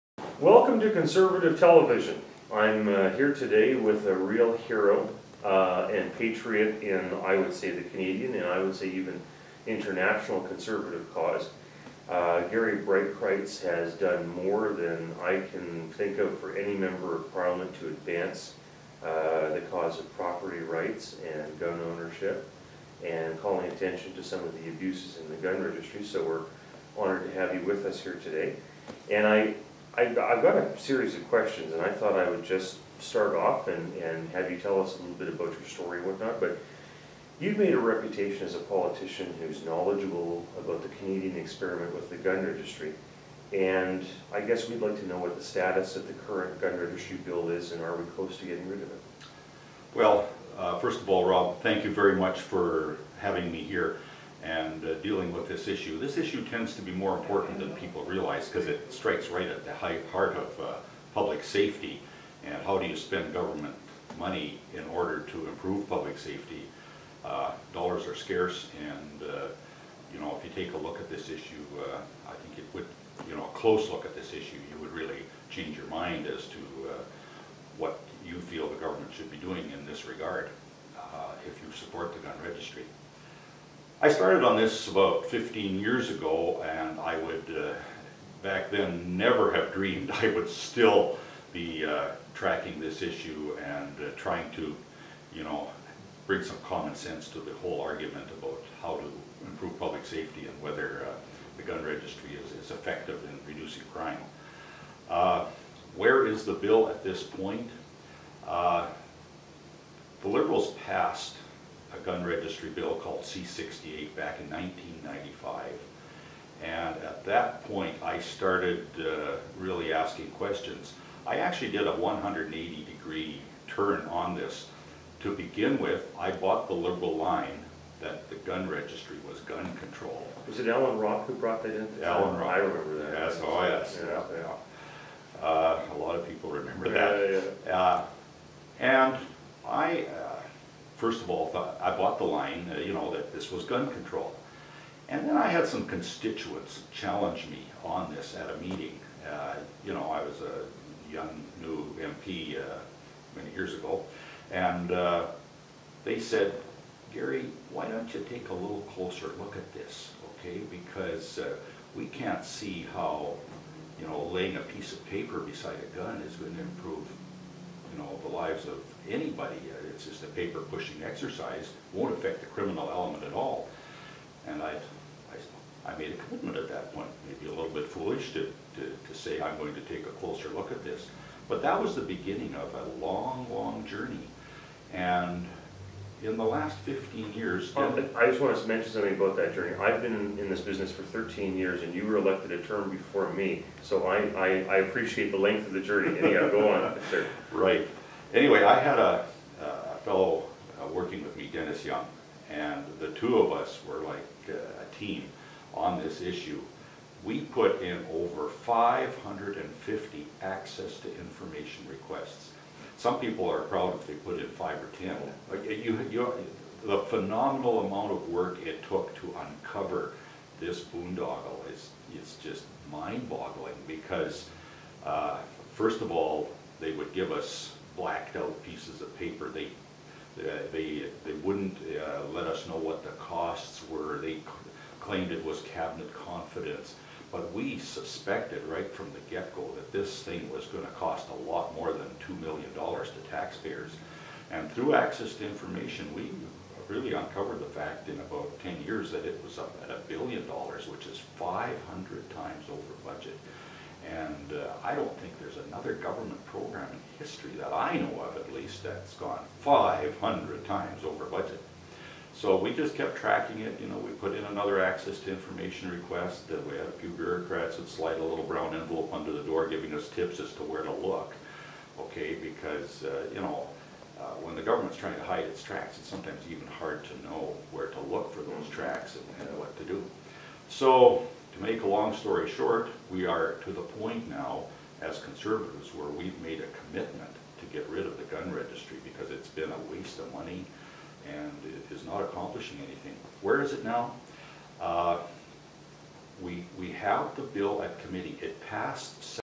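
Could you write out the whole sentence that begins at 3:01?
But that was the beginning of a long, long journey.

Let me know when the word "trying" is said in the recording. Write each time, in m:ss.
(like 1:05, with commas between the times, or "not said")
1:34, 4:34.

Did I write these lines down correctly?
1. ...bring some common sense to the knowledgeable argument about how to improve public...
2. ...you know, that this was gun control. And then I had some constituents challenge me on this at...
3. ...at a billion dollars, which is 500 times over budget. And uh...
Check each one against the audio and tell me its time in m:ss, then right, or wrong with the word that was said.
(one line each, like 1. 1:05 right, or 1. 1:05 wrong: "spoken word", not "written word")
1. 1:36 wrong: "whole", not "knowledgeable"
2. 2:22 right
3. 4:09 right.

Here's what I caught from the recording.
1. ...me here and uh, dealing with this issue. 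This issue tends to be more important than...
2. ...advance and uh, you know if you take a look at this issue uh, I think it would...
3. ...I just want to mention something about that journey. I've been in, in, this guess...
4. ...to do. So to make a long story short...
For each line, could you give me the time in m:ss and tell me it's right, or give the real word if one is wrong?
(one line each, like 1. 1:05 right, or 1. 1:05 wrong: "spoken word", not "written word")
1. 0:53 right
2. 1:08 wrong: "scarce", not "advance"
3. 3:08 wrong: "business", not "guess"
4. 4:39 right.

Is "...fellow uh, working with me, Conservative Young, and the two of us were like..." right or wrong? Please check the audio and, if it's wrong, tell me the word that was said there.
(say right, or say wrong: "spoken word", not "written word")
wrong: "Dennis", not "Conservative".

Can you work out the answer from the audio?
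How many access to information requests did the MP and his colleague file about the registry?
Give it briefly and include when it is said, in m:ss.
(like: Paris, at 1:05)
over 550, at 3:28.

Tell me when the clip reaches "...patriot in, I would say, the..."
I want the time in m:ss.
0:06.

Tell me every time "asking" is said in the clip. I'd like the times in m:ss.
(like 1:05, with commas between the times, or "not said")
1:59.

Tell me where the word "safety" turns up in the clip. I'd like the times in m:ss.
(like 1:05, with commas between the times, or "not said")
1:01, 1:06, 1:40.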